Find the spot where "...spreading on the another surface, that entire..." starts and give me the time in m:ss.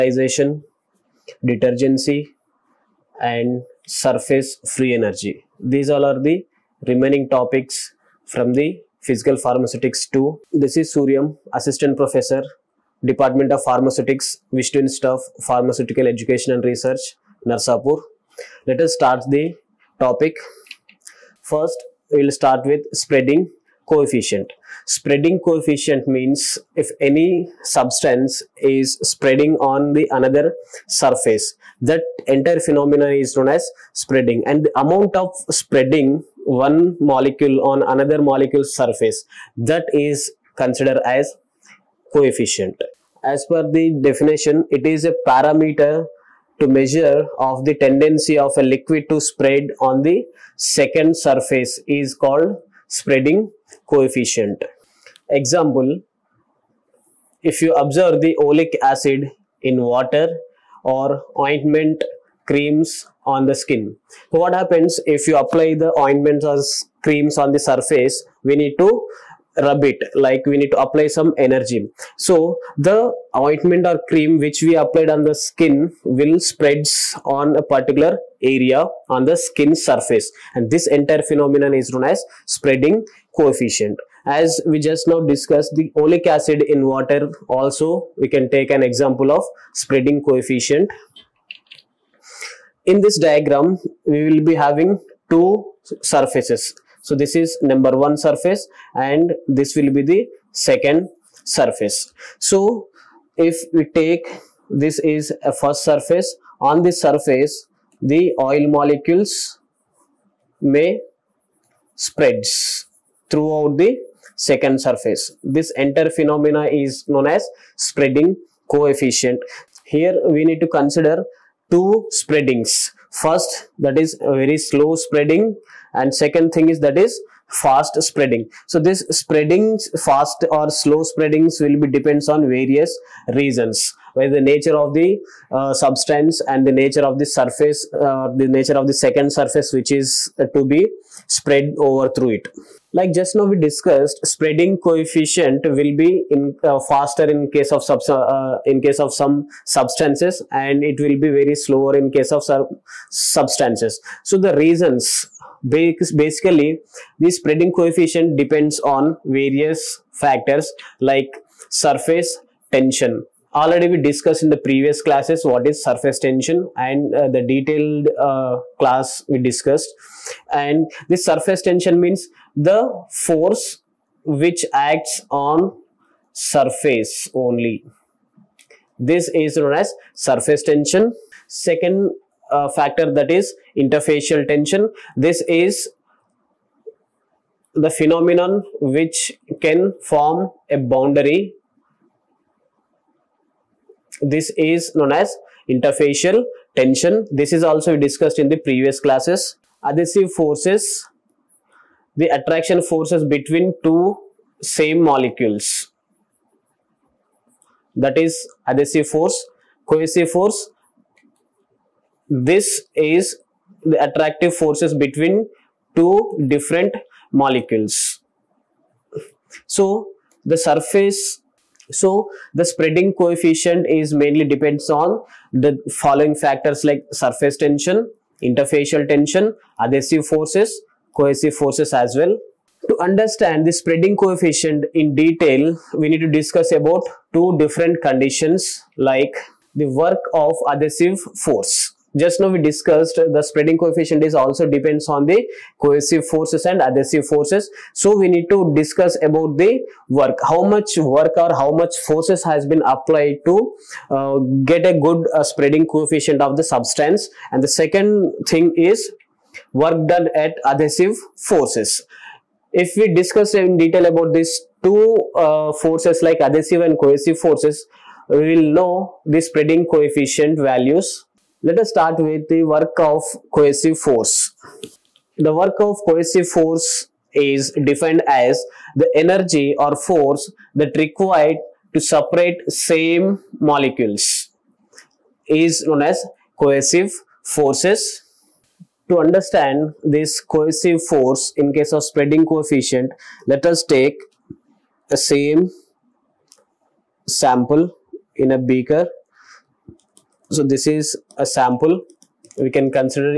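0:29.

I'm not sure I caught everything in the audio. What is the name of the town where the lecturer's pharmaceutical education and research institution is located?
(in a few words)
Narsapur.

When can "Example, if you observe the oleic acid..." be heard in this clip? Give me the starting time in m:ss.
0:55.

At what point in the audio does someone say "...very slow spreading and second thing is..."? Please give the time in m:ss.
2:04.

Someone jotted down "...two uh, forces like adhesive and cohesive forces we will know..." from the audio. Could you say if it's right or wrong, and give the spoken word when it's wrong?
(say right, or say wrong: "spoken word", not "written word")
right.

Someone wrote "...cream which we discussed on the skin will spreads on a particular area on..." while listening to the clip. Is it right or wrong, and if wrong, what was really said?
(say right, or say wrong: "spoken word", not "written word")
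wrong: "applied", not "discussed".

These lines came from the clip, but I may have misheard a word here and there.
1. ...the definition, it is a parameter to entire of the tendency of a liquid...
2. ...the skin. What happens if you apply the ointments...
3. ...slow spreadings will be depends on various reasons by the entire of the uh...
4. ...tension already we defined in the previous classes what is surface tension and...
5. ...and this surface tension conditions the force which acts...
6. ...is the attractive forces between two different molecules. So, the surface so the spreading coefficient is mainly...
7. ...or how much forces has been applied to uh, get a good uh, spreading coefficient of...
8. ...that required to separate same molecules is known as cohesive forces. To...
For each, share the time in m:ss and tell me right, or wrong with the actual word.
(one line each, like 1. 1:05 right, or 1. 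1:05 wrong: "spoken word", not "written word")
1. 0:43 wrong: "measure", not "entire"
2. 1:03 right
3. 2:10 wrong: "nature", not "entire"
4. 2:42 wrong: "discussed", not "defined"
5. 2:50 wrong: "means", not "conditions"
6. 3:32 right
7. 4:11 right
8. 4:40 right.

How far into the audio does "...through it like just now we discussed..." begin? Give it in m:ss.
2:22.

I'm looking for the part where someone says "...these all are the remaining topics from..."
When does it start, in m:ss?
0:05.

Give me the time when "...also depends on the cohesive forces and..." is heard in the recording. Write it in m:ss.
4:04.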